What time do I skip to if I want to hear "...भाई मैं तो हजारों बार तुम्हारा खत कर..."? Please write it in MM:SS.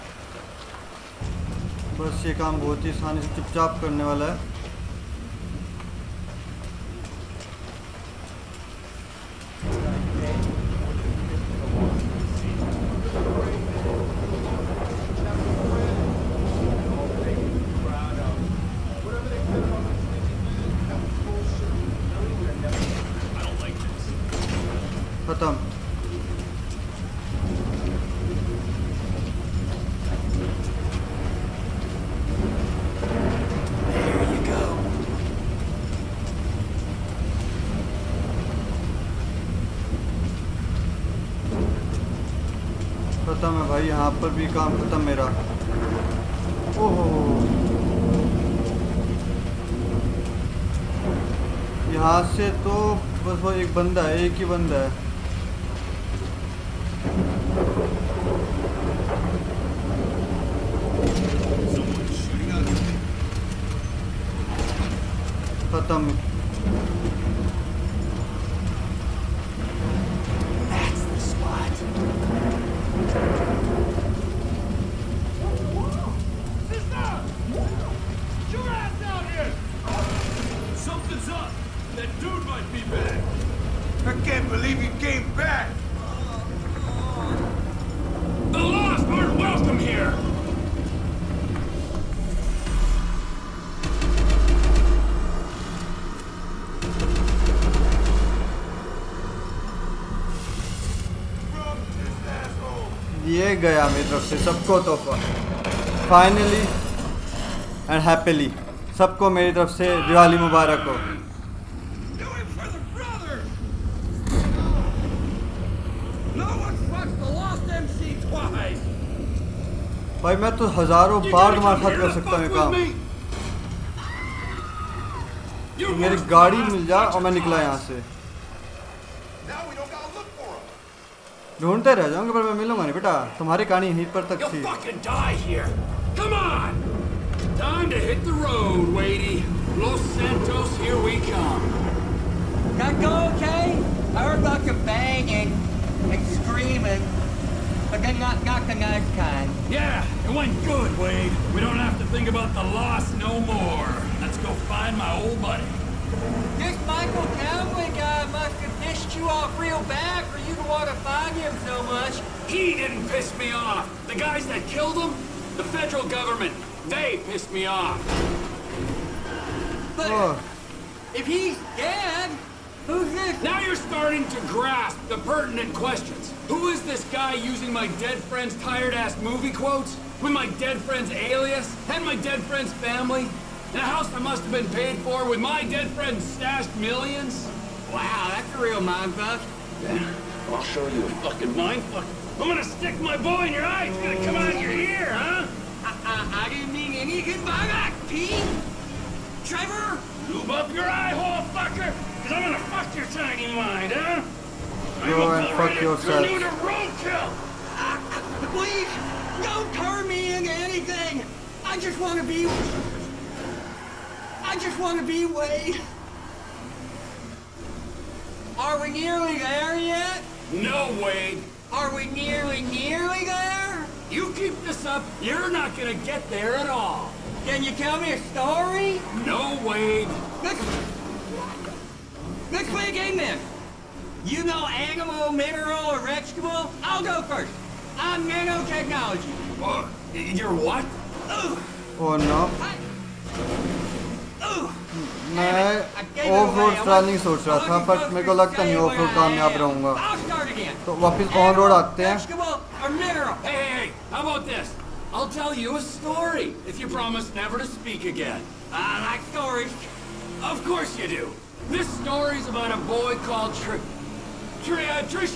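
02:00.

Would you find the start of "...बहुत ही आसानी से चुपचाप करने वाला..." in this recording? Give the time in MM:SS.
00:02.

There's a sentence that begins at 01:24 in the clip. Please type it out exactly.
I can't believe he came back.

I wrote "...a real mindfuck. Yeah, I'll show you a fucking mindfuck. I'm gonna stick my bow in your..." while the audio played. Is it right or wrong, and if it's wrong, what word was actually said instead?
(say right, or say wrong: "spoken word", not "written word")
right.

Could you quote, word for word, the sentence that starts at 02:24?
I heard about you banging and screaming.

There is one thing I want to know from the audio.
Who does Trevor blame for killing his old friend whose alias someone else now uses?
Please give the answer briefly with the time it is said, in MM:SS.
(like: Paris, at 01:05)
the federal government, at 02:45.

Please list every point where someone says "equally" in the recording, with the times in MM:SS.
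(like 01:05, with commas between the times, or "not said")
not said.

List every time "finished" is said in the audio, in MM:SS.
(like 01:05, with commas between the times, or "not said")
not said.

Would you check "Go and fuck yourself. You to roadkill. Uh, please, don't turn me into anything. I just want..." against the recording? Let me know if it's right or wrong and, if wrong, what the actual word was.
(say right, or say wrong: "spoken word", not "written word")
right.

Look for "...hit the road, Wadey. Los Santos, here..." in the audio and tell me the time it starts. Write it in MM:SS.
02:18.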